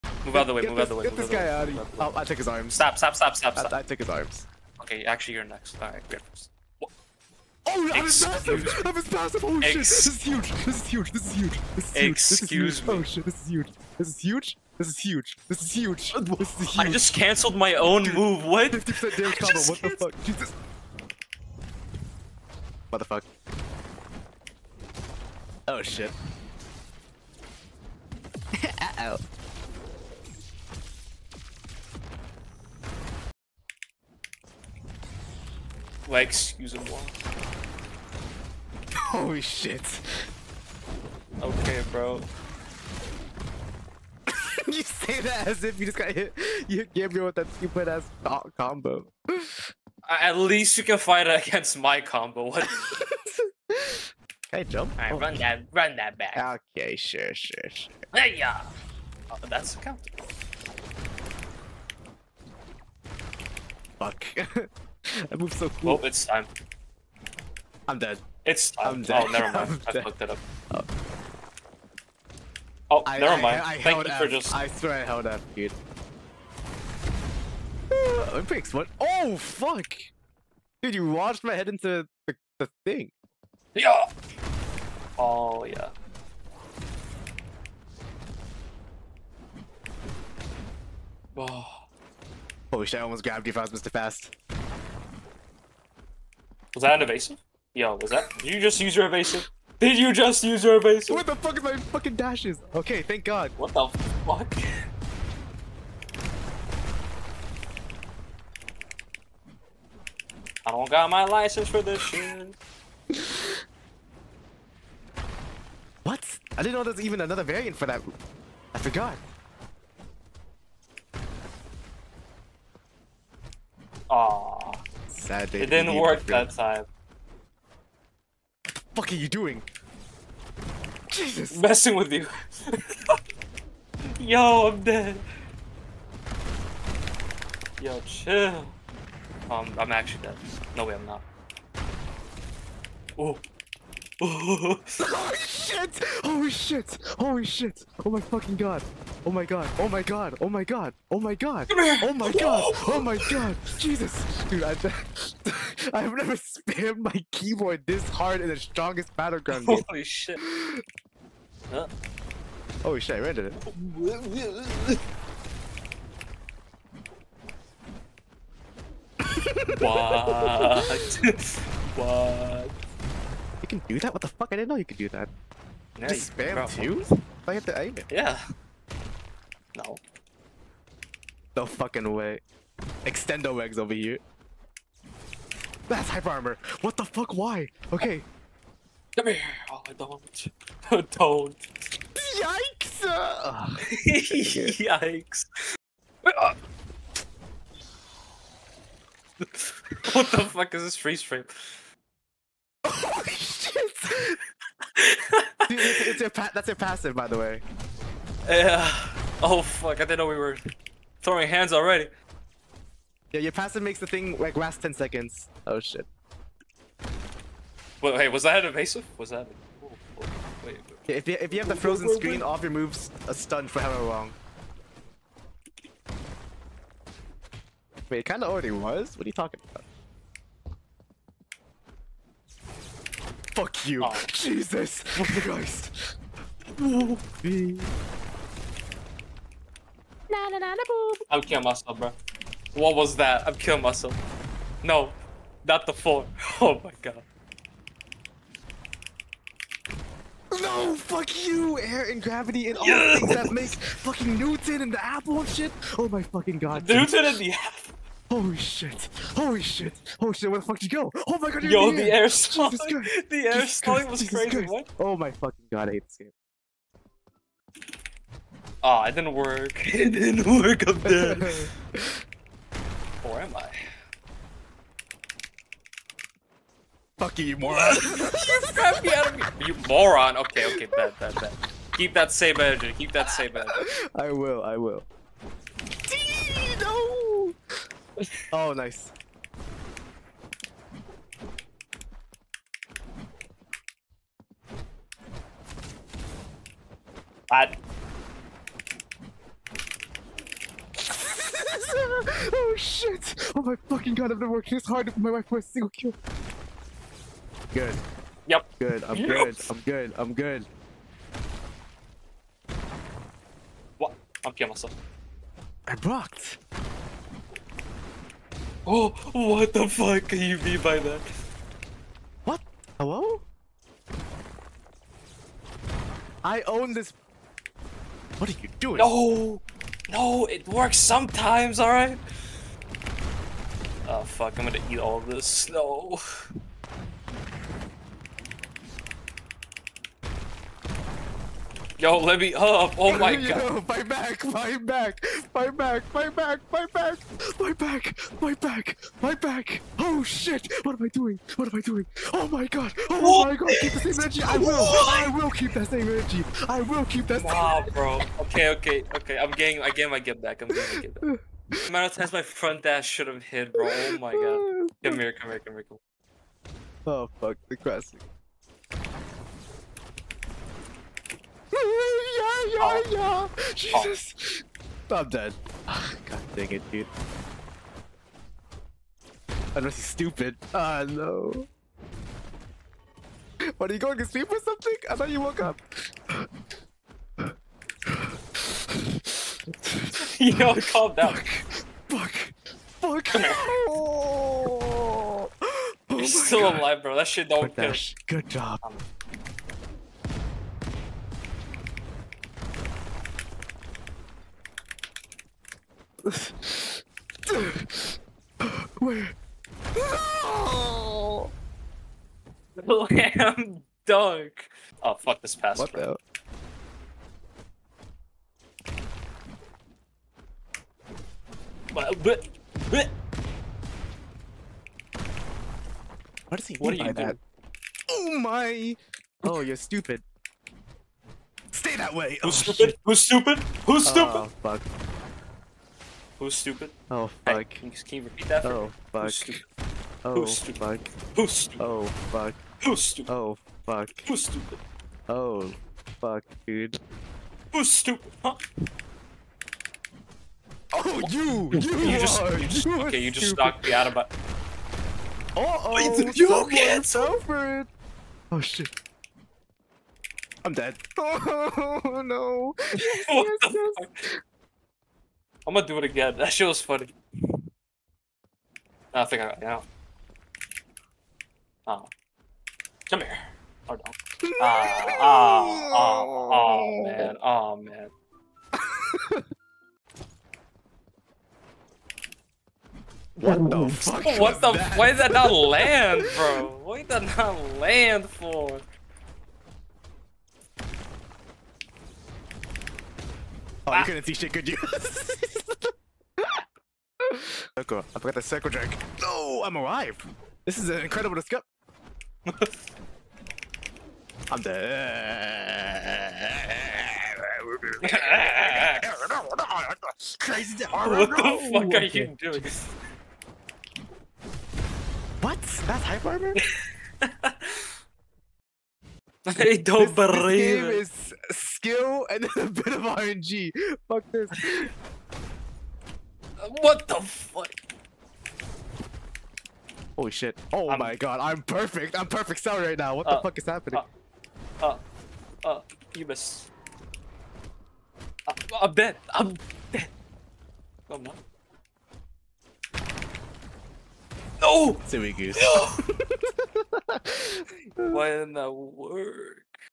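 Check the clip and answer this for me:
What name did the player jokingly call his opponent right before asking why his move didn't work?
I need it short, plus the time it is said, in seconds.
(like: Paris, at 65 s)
Silly goose, at 545 s.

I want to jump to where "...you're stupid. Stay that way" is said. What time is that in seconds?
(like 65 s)
429 s.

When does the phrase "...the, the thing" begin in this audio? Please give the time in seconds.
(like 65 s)
82 s.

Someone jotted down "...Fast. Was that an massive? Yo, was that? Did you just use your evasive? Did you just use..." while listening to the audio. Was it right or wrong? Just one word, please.
wrong.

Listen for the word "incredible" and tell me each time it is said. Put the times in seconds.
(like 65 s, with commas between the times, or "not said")
501 s.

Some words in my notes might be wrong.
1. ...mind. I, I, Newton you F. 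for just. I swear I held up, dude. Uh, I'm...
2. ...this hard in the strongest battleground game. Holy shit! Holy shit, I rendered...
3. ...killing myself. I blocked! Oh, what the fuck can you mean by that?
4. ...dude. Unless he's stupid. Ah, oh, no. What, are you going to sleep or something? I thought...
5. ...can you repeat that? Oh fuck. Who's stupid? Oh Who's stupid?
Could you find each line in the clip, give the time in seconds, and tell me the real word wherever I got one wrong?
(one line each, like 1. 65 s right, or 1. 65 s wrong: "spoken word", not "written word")
1. 73 s wrong: "Thank", not "Newton"
2. 157 s right
3. 314 s right
4. 376 s right
5. 437 s right.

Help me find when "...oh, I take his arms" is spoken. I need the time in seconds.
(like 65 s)
1 s.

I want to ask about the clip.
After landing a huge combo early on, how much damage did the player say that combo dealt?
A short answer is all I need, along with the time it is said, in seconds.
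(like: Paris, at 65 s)
50%, at 18 s.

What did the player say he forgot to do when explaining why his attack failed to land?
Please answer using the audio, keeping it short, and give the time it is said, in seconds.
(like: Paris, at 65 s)
the circle drag, at 498 s.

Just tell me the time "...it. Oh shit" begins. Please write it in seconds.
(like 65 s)
457 s.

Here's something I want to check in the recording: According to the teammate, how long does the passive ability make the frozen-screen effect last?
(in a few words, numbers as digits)
10 seconds.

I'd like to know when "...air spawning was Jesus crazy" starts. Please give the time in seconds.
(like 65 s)
263 s.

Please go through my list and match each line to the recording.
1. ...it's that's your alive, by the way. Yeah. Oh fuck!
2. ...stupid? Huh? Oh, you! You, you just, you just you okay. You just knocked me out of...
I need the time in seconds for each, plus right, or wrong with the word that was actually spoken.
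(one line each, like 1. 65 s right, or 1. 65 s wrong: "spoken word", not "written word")
1. 206 s wrong: "passive", not "alive"
2. 447 s right.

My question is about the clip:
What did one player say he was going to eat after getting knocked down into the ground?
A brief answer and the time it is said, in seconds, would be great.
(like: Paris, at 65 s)
snow, at 335 s.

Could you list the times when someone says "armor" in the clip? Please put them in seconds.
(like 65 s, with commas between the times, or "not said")
186 s, 516 s.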